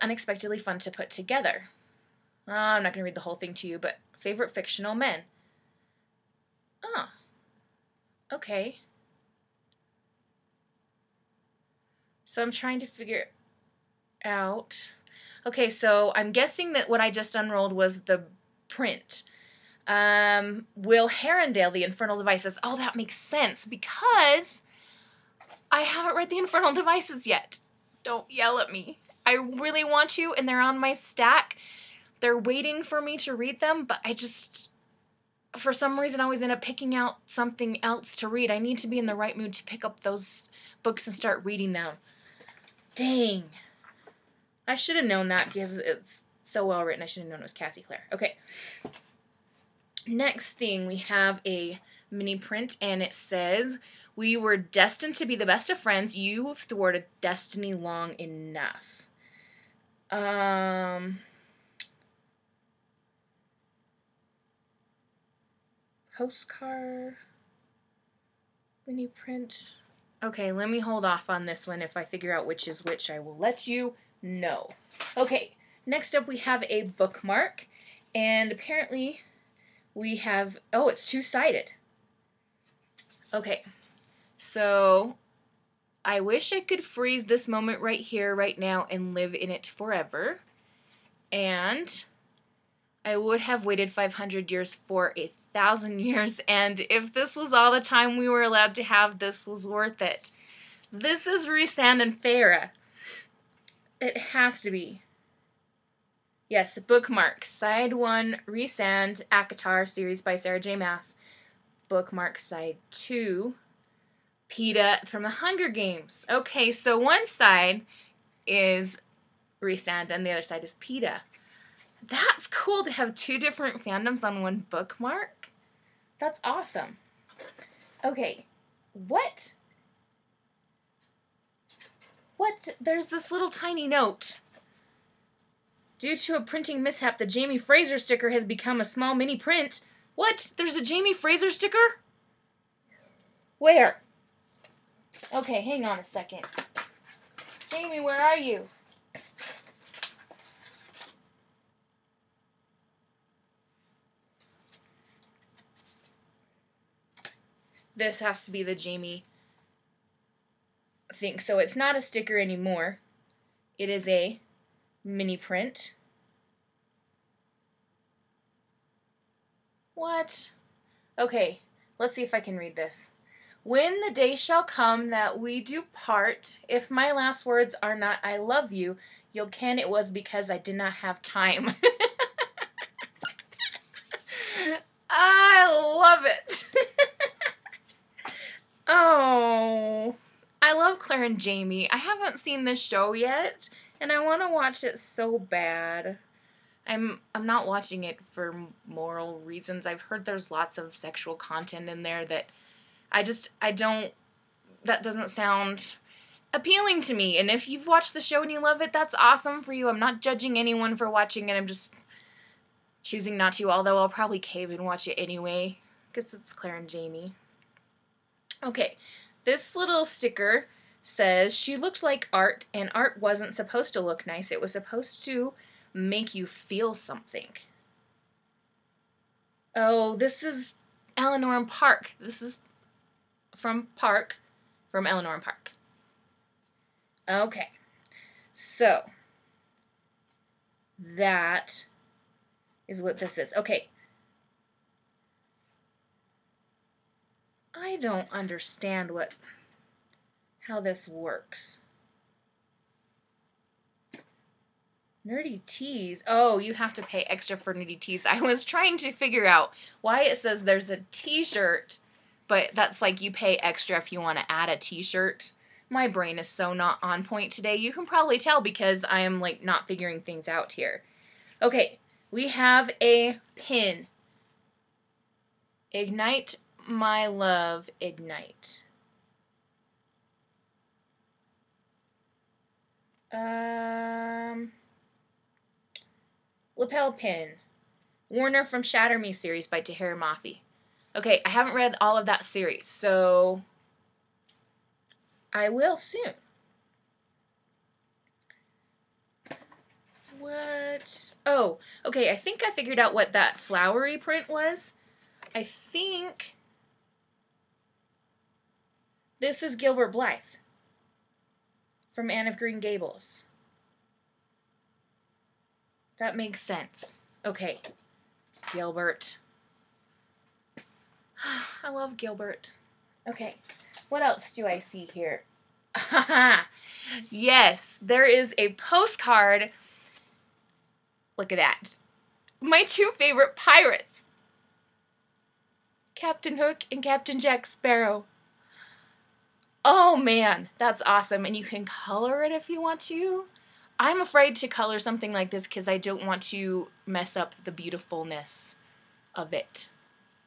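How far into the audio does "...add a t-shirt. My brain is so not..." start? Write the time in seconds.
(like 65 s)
264 s.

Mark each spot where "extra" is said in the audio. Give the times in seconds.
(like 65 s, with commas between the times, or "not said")
257 s, 263 s.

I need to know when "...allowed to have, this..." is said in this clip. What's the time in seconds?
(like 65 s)
98 s.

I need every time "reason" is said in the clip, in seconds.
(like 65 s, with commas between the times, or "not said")
36 s, 199 s.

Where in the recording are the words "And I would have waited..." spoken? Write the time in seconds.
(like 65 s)
91 s.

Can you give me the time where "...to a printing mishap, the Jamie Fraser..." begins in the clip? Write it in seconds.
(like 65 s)
136 s.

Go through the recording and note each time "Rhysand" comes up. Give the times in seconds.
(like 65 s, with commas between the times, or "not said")
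101 s, 108 s, 119 s.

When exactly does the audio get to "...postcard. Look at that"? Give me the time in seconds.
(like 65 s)
328 s.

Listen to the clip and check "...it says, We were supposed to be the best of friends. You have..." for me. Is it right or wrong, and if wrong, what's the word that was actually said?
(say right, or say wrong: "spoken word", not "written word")
wrong: "destined", not "supposed".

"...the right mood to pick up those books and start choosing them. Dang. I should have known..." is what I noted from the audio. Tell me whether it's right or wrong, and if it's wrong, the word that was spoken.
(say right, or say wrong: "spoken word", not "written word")
wrong: "reading", not "choosing".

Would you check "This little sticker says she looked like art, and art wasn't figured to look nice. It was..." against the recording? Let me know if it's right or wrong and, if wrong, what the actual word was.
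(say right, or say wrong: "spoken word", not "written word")
wrong: "supposed", not "figured".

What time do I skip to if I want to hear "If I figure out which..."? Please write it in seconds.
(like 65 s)
71 s.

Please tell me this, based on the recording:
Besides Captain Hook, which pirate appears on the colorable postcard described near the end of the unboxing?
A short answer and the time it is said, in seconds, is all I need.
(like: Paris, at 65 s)
Captain Jack Sparrow, at 337 s.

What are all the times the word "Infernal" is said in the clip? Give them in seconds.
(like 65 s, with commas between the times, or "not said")
21 s, 26 s.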